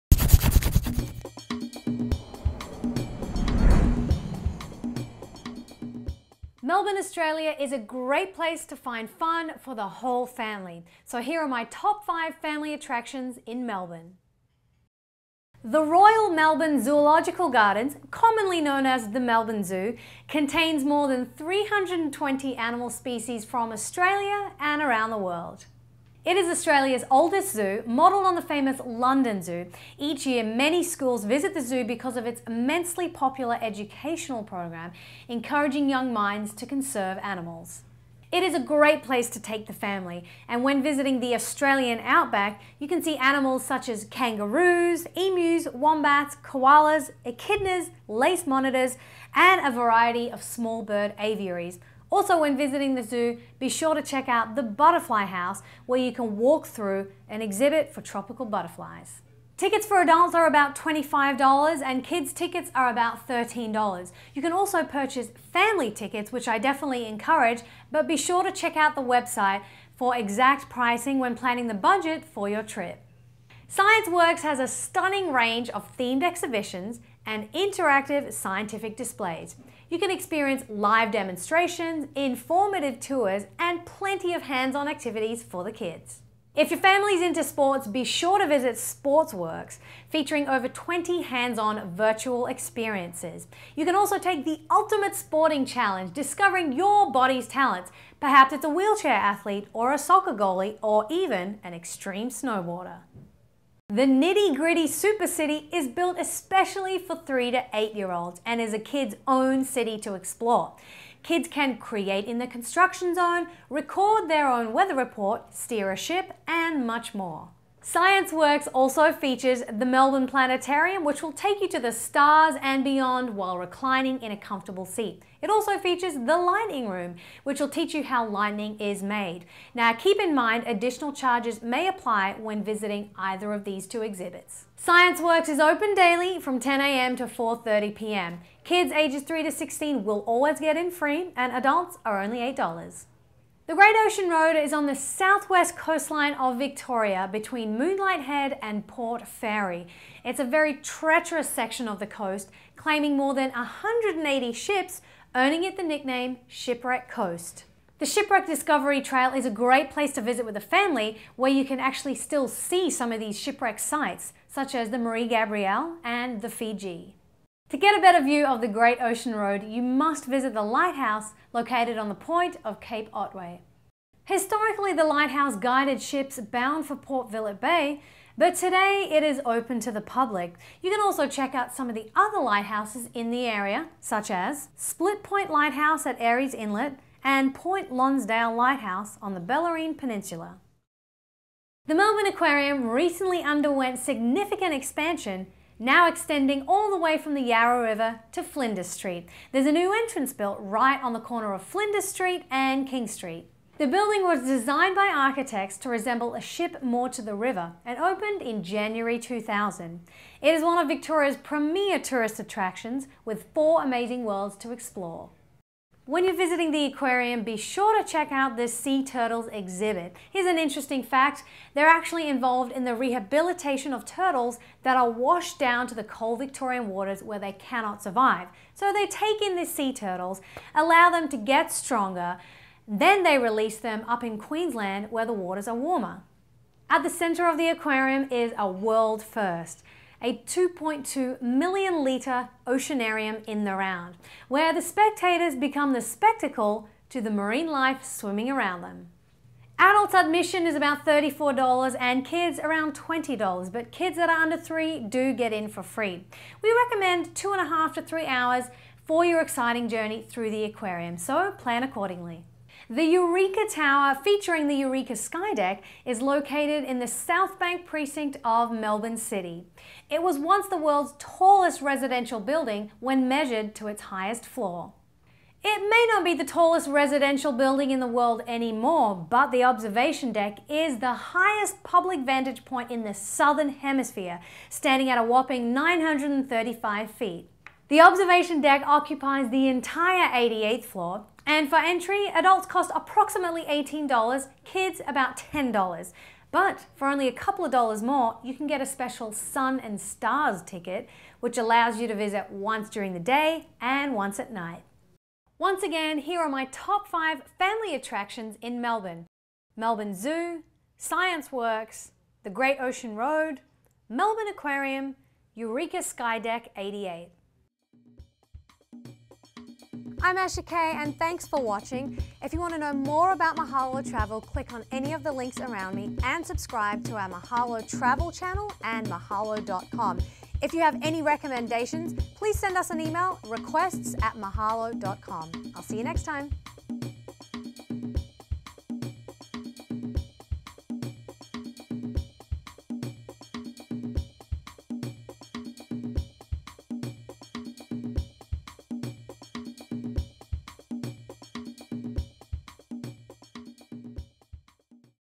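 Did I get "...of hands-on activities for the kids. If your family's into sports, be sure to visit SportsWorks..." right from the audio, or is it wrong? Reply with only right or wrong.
right.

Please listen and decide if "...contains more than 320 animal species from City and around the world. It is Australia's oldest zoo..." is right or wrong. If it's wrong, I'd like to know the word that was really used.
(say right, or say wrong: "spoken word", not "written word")
wrong: "Australia", not "City".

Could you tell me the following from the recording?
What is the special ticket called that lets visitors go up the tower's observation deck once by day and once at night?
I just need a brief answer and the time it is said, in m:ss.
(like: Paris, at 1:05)
Sun and Stars, at 4:59.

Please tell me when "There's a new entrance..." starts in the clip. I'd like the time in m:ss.
3:19.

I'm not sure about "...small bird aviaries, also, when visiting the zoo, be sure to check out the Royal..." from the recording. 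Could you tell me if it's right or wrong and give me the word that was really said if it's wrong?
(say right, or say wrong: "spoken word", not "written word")
wrong: "Butterfly", not "Royal".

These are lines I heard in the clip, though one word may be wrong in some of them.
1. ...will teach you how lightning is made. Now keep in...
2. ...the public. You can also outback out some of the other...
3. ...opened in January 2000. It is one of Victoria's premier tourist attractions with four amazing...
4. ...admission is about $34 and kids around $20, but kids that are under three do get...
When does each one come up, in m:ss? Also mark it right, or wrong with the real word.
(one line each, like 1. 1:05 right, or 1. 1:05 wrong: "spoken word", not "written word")
1. 2:07 right
2. 2:59 wrong: "check", not "outback"
3. 3:27 right
4. 4:10 right.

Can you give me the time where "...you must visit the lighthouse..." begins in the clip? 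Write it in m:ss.
2:49.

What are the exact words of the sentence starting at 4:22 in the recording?
The Eureka Tower, featuring the Eureka Skydeck, is located in the South Bank precinct of Melbourne City.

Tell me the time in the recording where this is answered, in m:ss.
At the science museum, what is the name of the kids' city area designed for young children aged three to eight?
1:44.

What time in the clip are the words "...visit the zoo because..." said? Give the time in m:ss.
0:31.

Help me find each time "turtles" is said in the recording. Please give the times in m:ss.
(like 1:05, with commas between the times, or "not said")
3:39, 3:44, 3:49.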